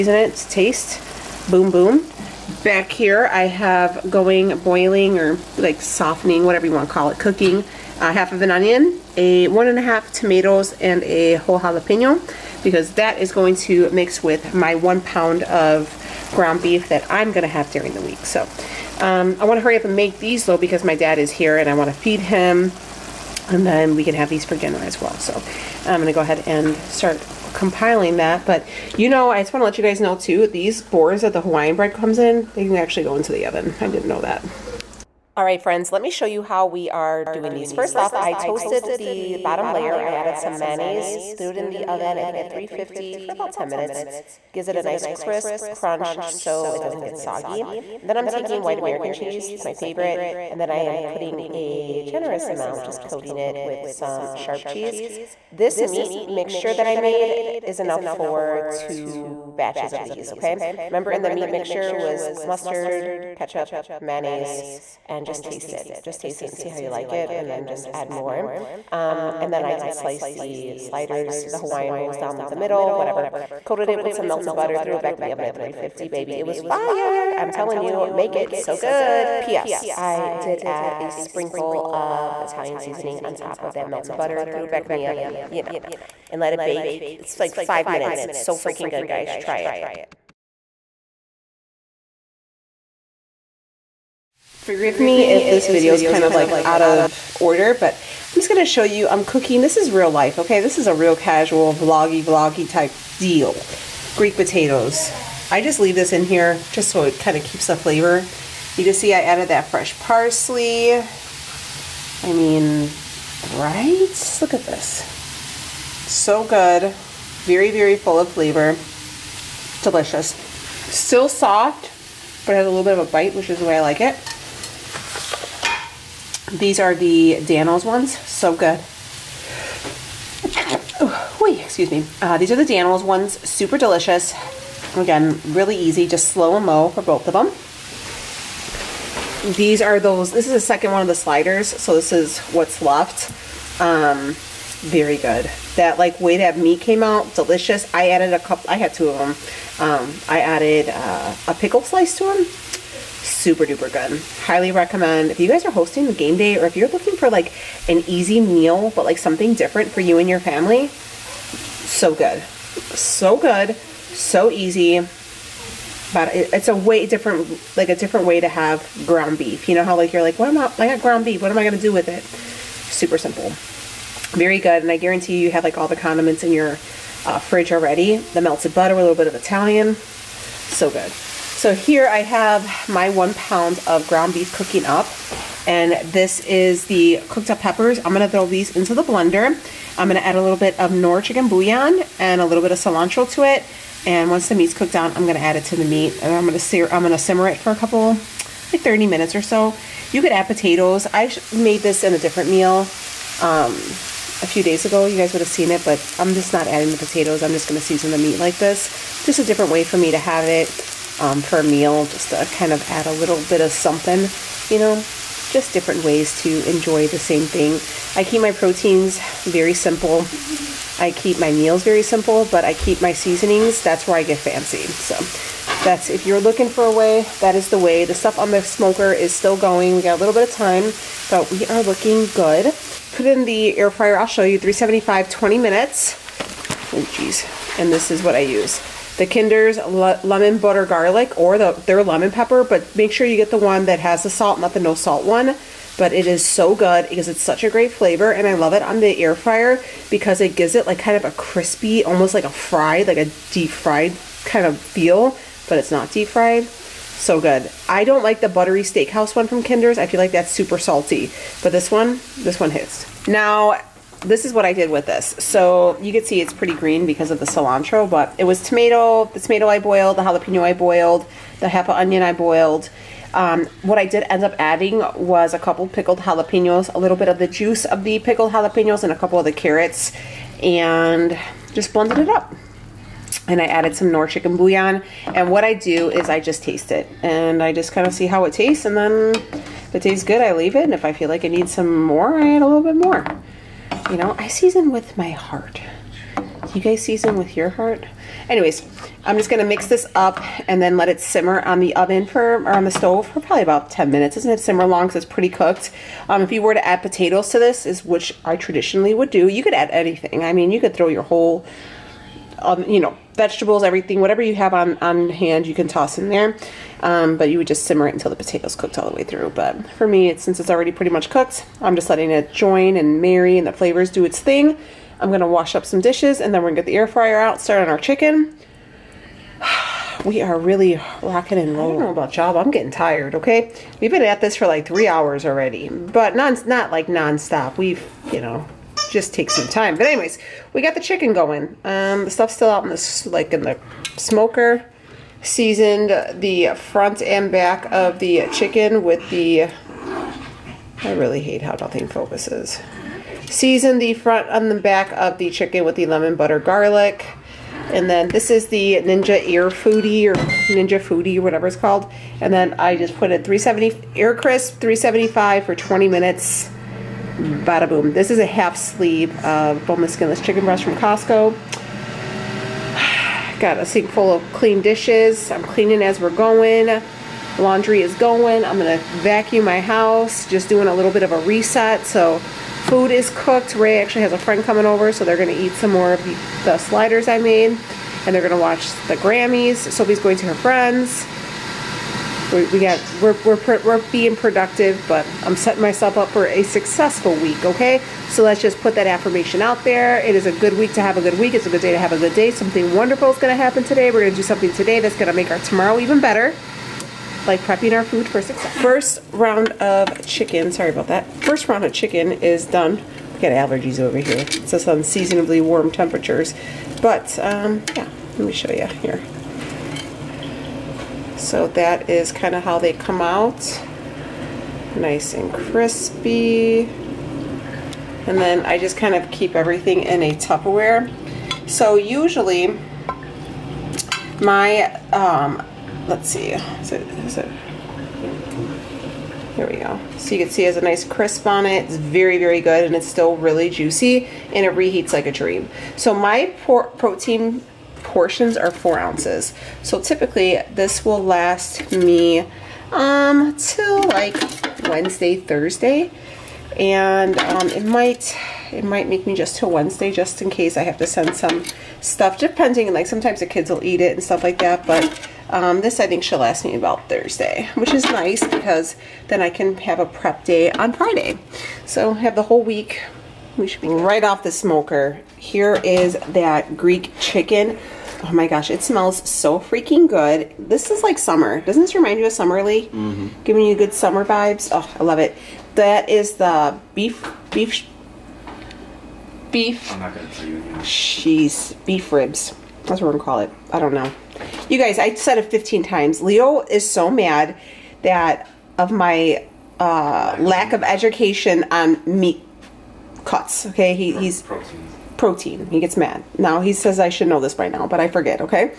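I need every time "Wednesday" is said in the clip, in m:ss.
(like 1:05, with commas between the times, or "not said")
7:34, 7:39.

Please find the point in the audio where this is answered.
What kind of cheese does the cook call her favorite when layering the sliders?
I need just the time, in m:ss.
0:48.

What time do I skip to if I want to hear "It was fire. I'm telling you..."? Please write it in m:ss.
1:16.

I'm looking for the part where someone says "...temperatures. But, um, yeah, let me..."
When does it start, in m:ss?
6:55.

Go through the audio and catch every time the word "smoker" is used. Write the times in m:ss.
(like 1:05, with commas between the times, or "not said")
3:48, 5:44, 7:54.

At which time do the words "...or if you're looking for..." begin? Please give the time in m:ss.
2:36.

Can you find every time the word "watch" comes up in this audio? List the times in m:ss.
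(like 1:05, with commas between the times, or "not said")
6:28.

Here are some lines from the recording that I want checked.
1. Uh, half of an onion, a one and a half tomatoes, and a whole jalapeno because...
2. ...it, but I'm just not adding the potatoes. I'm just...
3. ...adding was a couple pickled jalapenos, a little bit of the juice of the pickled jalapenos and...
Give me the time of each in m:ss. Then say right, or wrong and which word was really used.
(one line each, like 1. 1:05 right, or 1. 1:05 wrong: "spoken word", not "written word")
1. 0:07 right
2. 3:25 right
3. 4:34 right.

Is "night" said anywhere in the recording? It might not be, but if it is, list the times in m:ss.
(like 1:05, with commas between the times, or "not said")
not said.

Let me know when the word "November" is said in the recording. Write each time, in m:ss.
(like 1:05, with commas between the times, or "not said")
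not said.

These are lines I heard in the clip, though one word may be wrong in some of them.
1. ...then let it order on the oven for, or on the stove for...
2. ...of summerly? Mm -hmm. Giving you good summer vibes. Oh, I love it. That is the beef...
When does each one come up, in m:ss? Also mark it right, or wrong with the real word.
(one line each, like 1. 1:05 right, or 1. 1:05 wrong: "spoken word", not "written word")
1. 5:00 wrong: "simmer", not "order"
2. 8:02 right.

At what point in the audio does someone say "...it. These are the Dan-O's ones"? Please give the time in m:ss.
2:04.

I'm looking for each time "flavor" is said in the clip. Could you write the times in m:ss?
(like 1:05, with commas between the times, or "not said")
1:47, 1:58, 4:07, 5:23.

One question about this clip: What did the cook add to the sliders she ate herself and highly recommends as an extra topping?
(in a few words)
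A pickle slice.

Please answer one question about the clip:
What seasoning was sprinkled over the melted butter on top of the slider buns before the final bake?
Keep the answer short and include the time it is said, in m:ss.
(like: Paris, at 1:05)
Italian seasoning, at 1:22.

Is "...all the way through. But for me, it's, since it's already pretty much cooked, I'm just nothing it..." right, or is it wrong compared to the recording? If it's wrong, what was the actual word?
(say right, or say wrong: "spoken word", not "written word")
wrong: "letting", not "nothing".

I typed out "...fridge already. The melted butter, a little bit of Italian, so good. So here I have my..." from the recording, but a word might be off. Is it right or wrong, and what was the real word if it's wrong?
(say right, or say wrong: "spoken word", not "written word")
right.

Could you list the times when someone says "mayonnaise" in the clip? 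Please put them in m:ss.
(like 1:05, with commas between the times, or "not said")
0:40, 1:04.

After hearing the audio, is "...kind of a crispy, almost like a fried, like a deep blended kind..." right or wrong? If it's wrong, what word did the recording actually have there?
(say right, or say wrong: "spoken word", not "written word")
wrong: "fried", not "blended".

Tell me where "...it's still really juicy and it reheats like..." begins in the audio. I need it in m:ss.
7:22.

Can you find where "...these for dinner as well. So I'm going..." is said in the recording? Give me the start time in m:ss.
0:24.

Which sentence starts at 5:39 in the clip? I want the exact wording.
But anyways, we got the chicken going.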